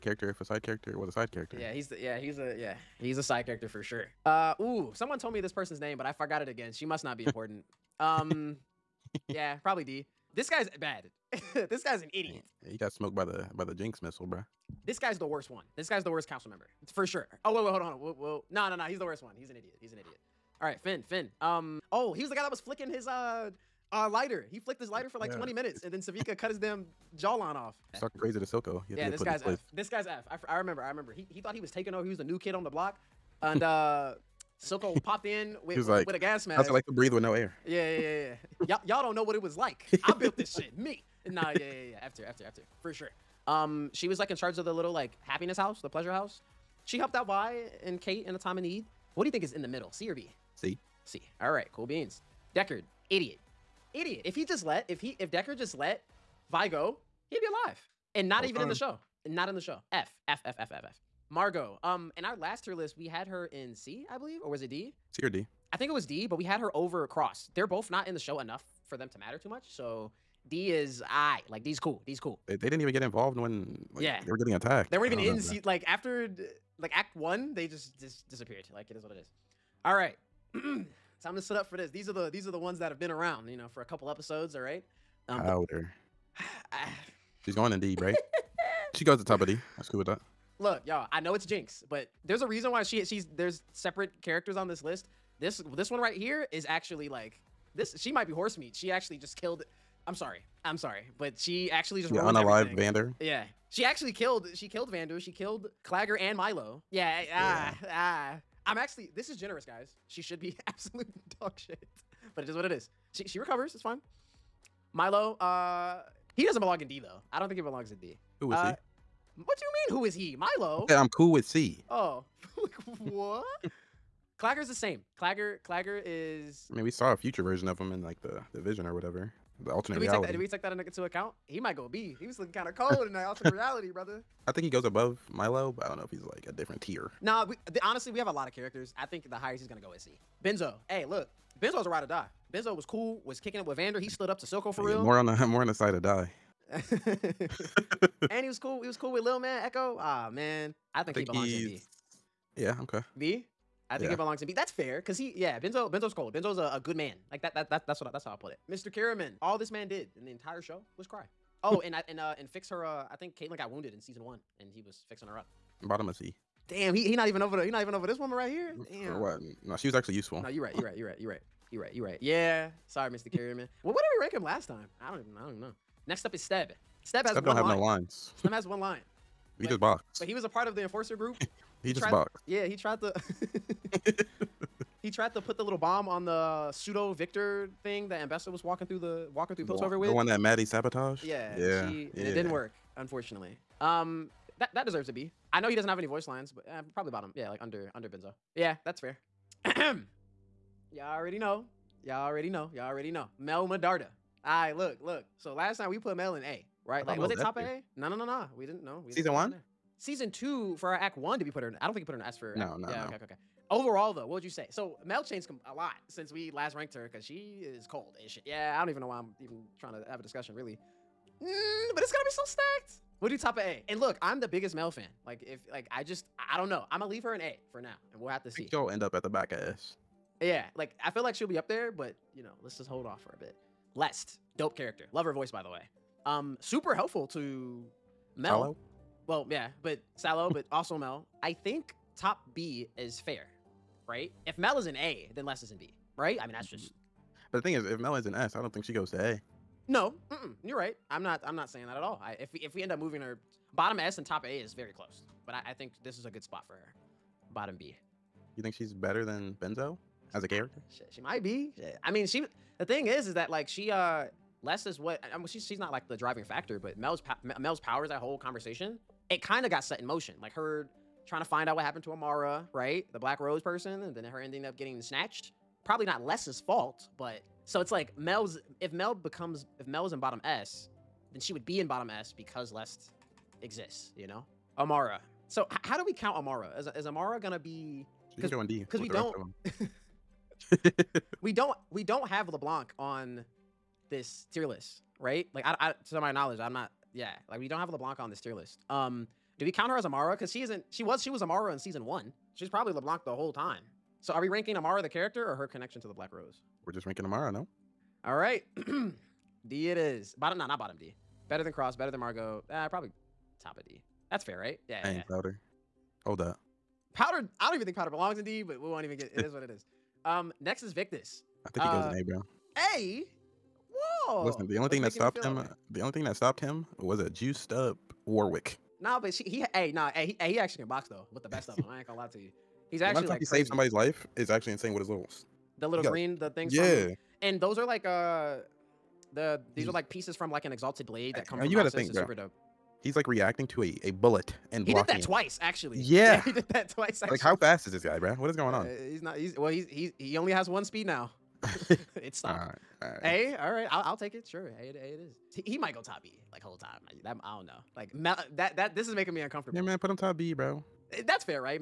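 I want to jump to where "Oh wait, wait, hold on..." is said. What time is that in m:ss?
0:17.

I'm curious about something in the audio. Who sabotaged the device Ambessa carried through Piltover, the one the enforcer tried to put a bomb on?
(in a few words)
Maddie.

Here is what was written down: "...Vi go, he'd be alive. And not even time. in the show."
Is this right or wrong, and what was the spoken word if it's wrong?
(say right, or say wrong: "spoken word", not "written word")
right.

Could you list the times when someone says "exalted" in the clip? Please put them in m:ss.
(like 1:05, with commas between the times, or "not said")
5:40.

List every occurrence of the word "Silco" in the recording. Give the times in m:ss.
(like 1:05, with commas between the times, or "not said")
0:28, 0:34, 2:24.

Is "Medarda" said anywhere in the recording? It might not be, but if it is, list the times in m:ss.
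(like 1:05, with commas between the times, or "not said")
3:23.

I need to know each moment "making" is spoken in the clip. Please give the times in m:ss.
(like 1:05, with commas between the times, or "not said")
5:59.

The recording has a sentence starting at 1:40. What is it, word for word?
I'm sorry, but she actually just yeah, Alive, Vander.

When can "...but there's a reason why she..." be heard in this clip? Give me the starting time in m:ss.
1:31.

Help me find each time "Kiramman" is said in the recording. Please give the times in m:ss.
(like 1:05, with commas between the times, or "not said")
2:38, 2:53.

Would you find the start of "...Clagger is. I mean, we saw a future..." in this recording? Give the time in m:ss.
2:05.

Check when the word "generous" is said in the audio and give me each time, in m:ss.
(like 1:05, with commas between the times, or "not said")
1:49.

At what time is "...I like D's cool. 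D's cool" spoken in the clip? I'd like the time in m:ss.
1:11.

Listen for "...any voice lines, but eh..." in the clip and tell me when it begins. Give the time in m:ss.
3:15.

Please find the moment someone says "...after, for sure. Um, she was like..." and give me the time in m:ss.
0:42.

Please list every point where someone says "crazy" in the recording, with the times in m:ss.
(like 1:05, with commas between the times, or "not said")
0:28, 5:33.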